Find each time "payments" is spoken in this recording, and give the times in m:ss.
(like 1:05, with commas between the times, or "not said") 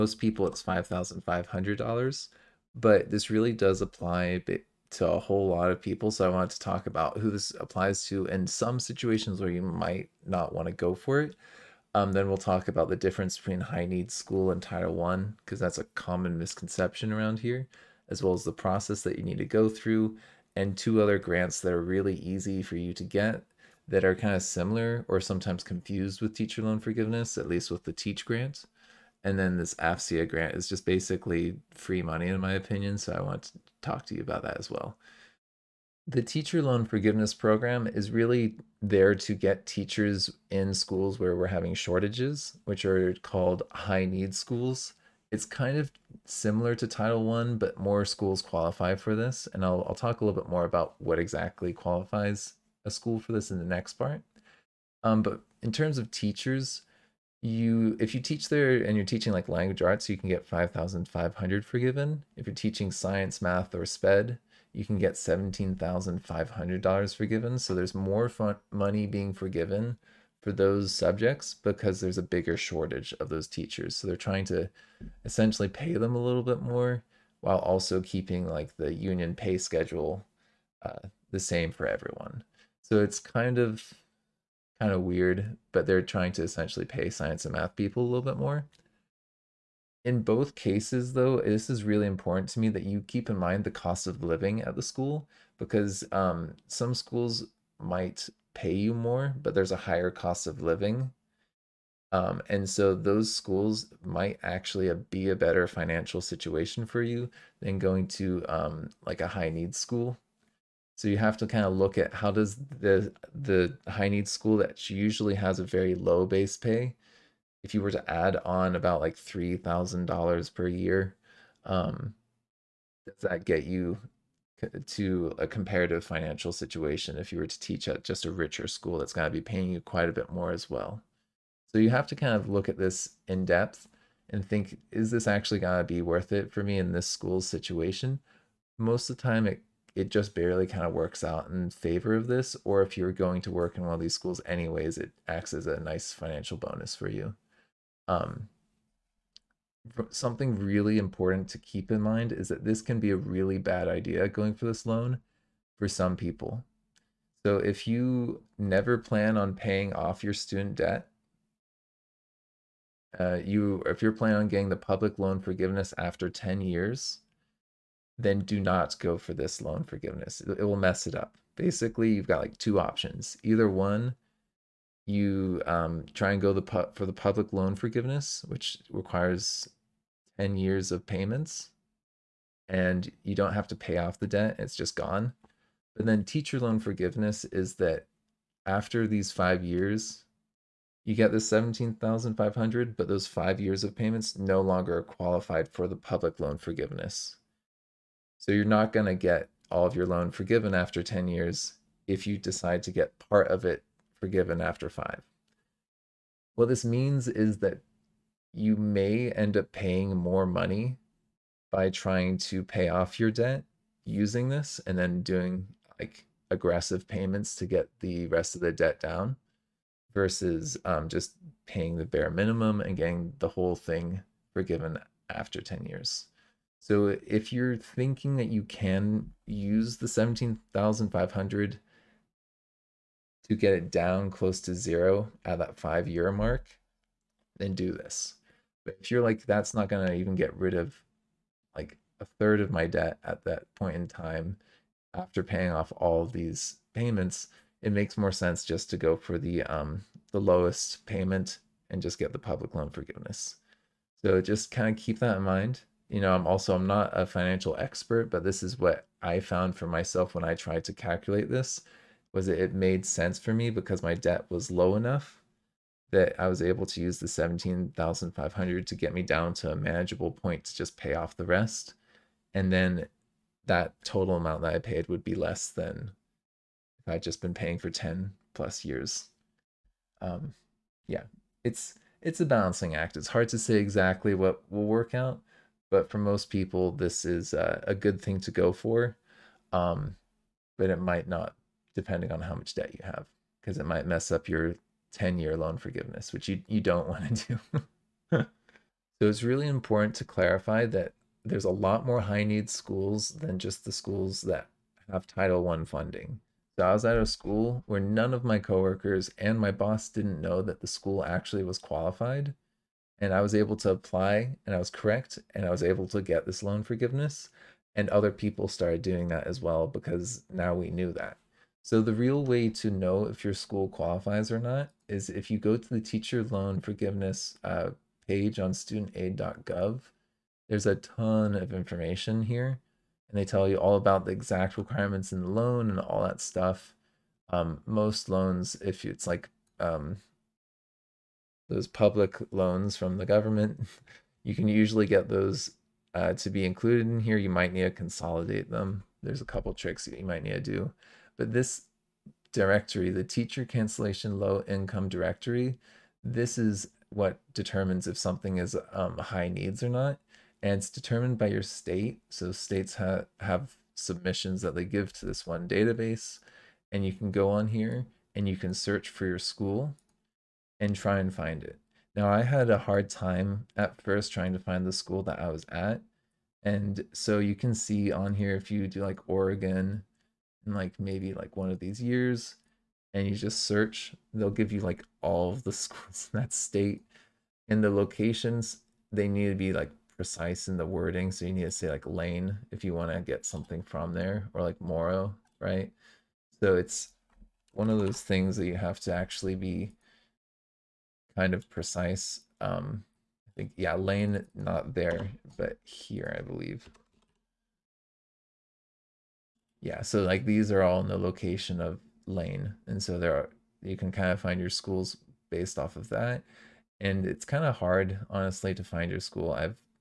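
3:01, 3:13, 3:37, 4:06, 4:11.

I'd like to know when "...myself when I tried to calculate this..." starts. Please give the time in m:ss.
4:19.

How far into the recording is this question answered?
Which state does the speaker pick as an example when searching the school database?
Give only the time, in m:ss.
6:19.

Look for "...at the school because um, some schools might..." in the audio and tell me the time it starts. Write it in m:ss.
1:34.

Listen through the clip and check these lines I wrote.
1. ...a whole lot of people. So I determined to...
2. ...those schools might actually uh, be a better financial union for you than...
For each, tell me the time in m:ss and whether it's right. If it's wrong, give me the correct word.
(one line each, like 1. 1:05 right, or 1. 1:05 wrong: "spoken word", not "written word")
1. 0:05 wrong: "wanted", not "determined"
2. 1:42 wrong: "situation", not "union".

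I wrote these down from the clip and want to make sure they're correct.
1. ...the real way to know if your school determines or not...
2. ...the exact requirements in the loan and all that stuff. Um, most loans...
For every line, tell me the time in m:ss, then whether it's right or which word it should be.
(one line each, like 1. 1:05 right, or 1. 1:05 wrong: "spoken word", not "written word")
1. 5:22 wrong: "qualifies", not "determines"
2. 5:34 right.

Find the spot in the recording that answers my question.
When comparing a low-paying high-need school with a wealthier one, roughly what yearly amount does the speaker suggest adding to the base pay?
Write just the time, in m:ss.
1:59.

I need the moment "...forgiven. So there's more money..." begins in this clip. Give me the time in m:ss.
1:07.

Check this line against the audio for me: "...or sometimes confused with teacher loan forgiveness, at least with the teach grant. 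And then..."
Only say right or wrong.
right.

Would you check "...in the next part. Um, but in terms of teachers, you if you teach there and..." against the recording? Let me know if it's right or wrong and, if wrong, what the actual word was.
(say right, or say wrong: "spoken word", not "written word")
right.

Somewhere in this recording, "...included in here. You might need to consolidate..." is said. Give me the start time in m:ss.
5:46.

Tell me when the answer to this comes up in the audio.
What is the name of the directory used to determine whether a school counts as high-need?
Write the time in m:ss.
5:53.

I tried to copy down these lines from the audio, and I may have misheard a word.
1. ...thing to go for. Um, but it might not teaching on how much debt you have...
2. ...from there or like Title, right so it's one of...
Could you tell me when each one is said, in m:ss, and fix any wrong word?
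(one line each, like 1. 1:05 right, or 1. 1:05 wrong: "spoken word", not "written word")
1. 4:48 wrong: "depending", not "teaching"
2. 6:33 wrong: "Moro", not "Title".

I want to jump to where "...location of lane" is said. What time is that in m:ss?
6:51.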